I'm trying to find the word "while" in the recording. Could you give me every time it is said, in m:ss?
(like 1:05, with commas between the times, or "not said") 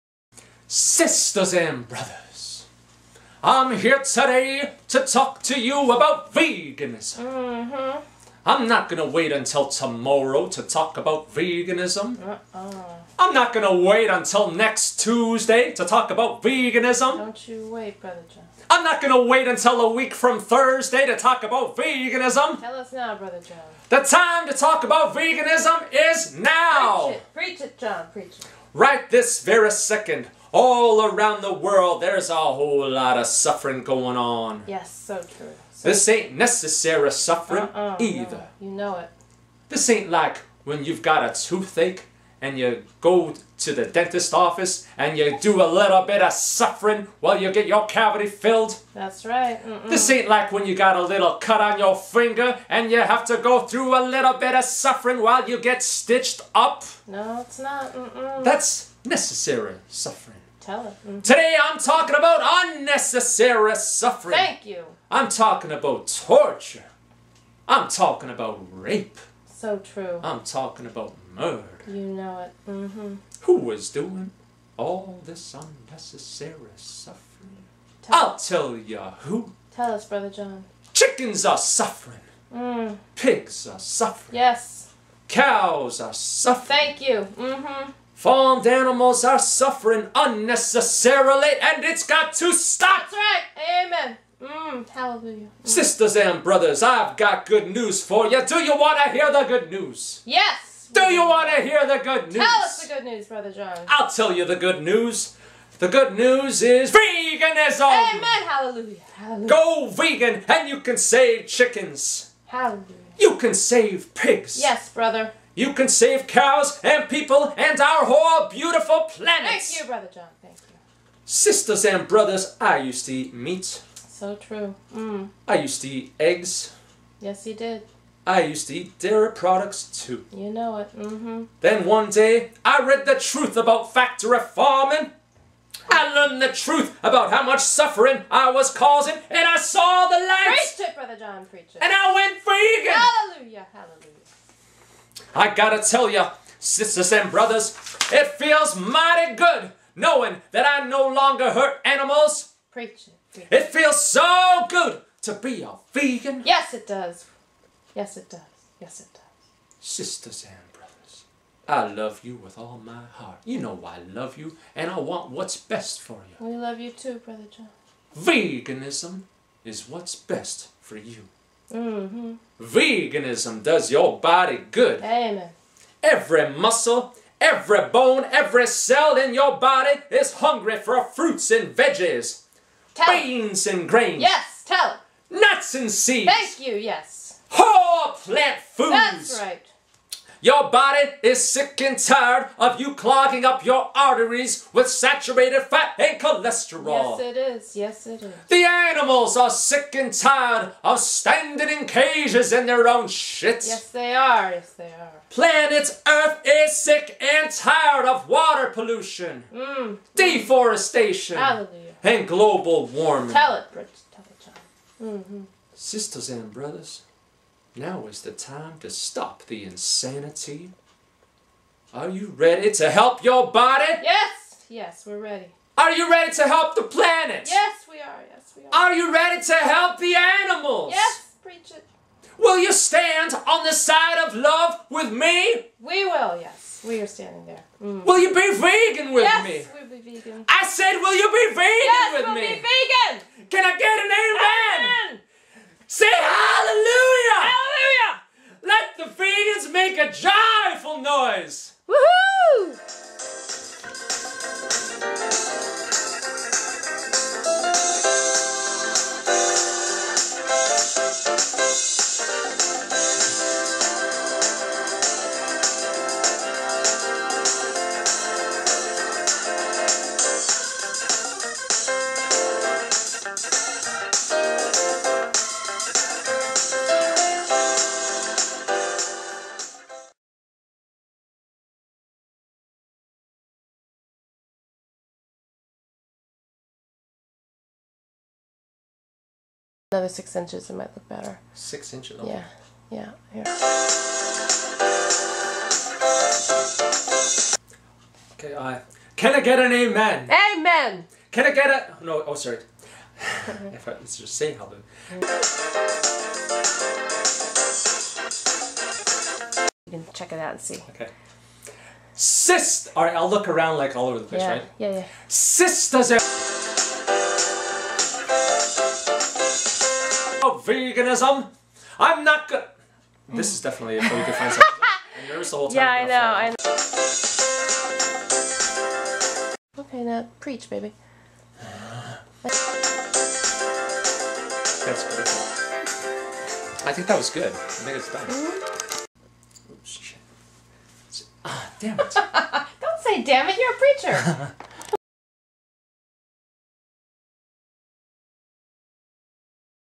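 0:47, 0:55.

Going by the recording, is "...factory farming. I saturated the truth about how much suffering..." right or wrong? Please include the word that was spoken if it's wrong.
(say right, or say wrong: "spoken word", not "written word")
wrong: "learned", not "saturated".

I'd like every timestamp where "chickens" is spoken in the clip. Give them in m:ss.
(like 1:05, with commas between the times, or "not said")
1:20, 1:51.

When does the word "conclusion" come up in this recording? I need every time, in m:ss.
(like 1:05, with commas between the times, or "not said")
not said.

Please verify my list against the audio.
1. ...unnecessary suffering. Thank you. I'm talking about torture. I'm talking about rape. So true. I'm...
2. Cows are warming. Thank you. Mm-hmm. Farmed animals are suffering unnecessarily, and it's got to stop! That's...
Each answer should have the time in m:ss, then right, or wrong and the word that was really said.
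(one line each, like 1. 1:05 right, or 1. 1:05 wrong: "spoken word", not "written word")
1. 1:02 right
2. 1:25 wrong: "suffering", not "warming".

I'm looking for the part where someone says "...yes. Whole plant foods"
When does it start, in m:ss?
3:06.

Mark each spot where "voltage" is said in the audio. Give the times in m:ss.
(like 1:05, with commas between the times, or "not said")
not said.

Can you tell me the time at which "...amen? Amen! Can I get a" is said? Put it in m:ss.
4:59.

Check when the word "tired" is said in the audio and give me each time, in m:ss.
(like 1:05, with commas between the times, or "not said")
3:11, 3:20, 3:27.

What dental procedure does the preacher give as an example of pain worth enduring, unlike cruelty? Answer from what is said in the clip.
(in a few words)
cavity filled.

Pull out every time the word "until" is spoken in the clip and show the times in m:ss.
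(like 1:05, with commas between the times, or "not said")
0:09, 0:14, 0:19.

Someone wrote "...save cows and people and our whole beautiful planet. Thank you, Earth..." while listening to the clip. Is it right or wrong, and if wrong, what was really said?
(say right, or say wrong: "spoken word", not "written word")
wrong: "Brother", not "Earth".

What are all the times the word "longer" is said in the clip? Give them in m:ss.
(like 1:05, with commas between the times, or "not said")
2:31.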